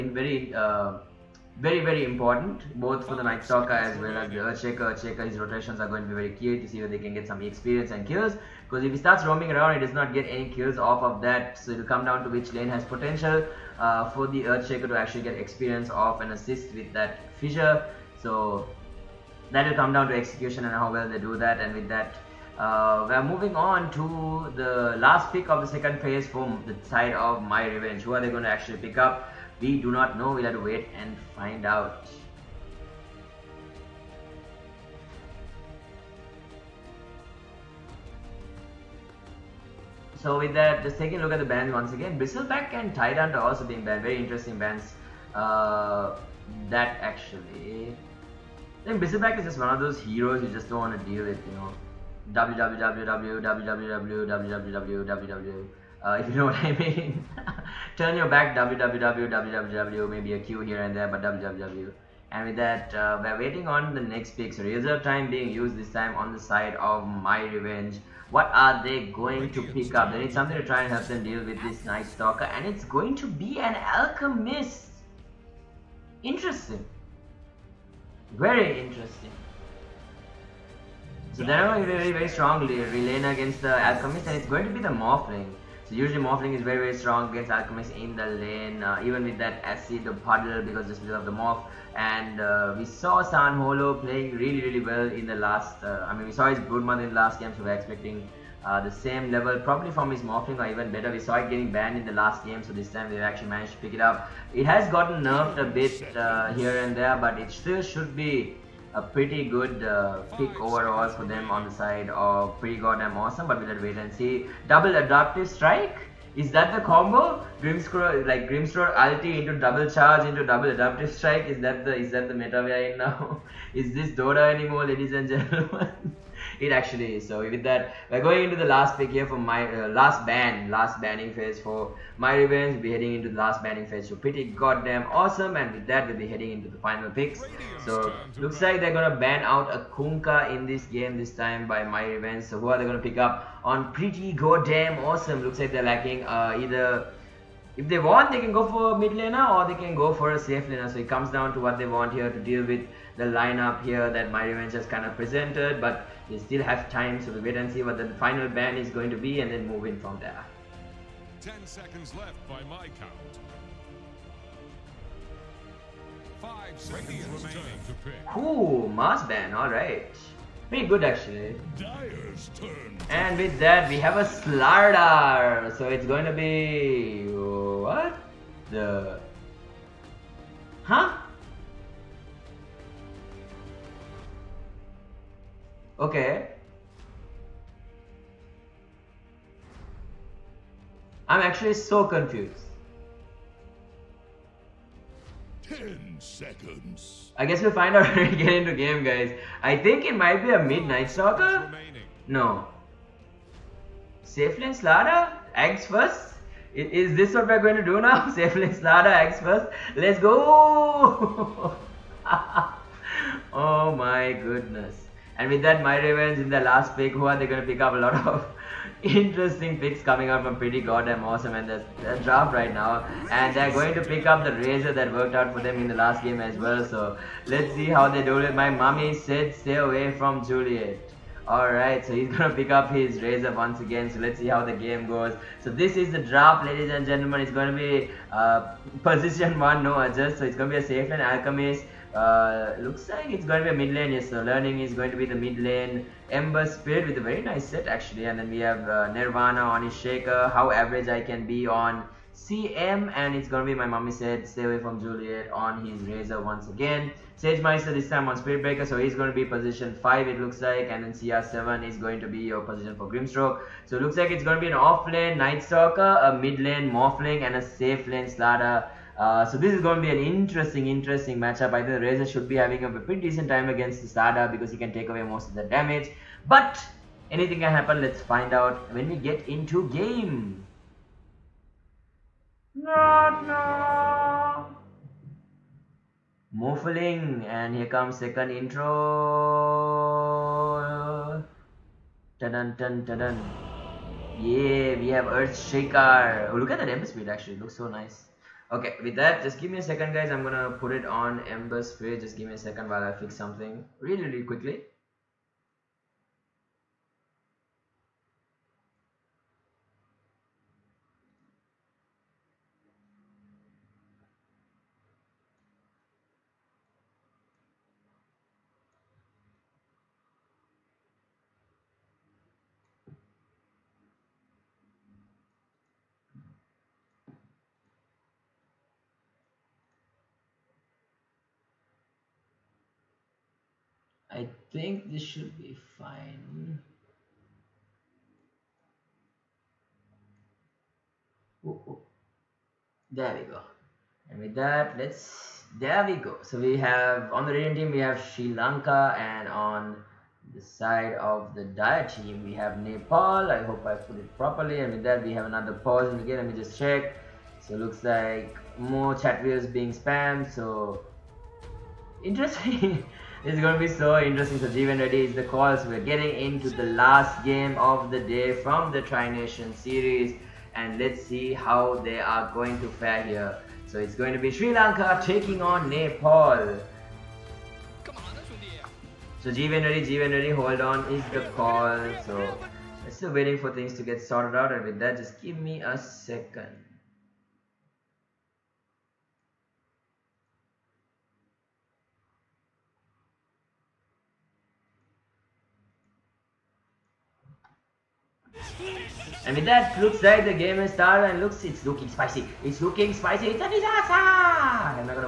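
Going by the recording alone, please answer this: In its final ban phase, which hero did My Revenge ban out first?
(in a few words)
Kunkka.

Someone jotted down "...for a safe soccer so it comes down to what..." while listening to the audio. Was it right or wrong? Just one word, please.
wrong.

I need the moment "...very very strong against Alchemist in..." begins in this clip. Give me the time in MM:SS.
01:26.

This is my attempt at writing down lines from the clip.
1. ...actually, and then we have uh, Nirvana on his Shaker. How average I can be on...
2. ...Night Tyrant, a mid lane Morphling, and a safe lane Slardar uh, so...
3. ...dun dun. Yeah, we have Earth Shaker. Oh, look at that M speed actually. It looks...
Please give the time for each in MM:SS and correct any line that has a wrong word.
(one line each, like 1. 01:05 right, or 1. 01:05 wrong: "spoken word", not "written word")
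1. 04:07 right
2. 04:25 wrong: "Stalker", not "Tyrant"
3. 04:52 right.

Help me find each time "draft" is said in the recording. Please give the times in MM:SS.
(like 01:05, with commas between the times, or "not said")
03:42, 03:56.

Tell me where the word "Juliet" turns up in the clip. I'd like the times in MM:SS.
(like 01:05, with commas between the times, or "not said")
03:50, 04:15.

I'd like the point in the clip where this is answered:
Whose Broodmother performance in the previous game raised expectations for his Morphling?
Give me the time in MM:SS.
01:33.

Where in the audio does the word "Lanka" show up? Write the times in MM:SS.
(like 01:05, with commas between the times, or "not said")
05:48, 06:14.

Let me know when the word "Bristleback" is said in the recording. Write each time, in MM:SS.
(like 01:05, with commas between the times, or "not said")
00:42, 00:49.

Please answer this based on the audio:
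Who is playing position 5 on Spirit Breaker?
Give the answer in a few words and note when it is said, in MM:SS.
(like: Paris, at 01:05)
Sage Meister, at 04:17.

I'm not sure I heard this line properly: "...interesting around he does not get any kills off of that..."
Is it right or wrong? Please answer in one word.
wrong.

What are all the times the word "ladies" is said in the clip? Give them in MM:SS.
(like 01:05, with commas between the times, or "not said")
02:04, 03:56.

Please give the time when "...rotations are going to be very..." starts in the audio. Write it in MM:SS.
00:05.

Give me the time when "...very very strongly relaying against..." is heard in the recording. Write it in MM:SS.
01:21.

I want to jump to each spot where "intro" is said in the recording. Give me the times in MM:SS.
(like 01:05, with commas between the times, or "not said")
04:48.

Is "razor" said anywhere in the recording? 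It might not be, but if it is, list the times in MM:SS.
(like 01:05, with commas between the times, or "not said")
03:44, 03:53, 04:16, 04:32.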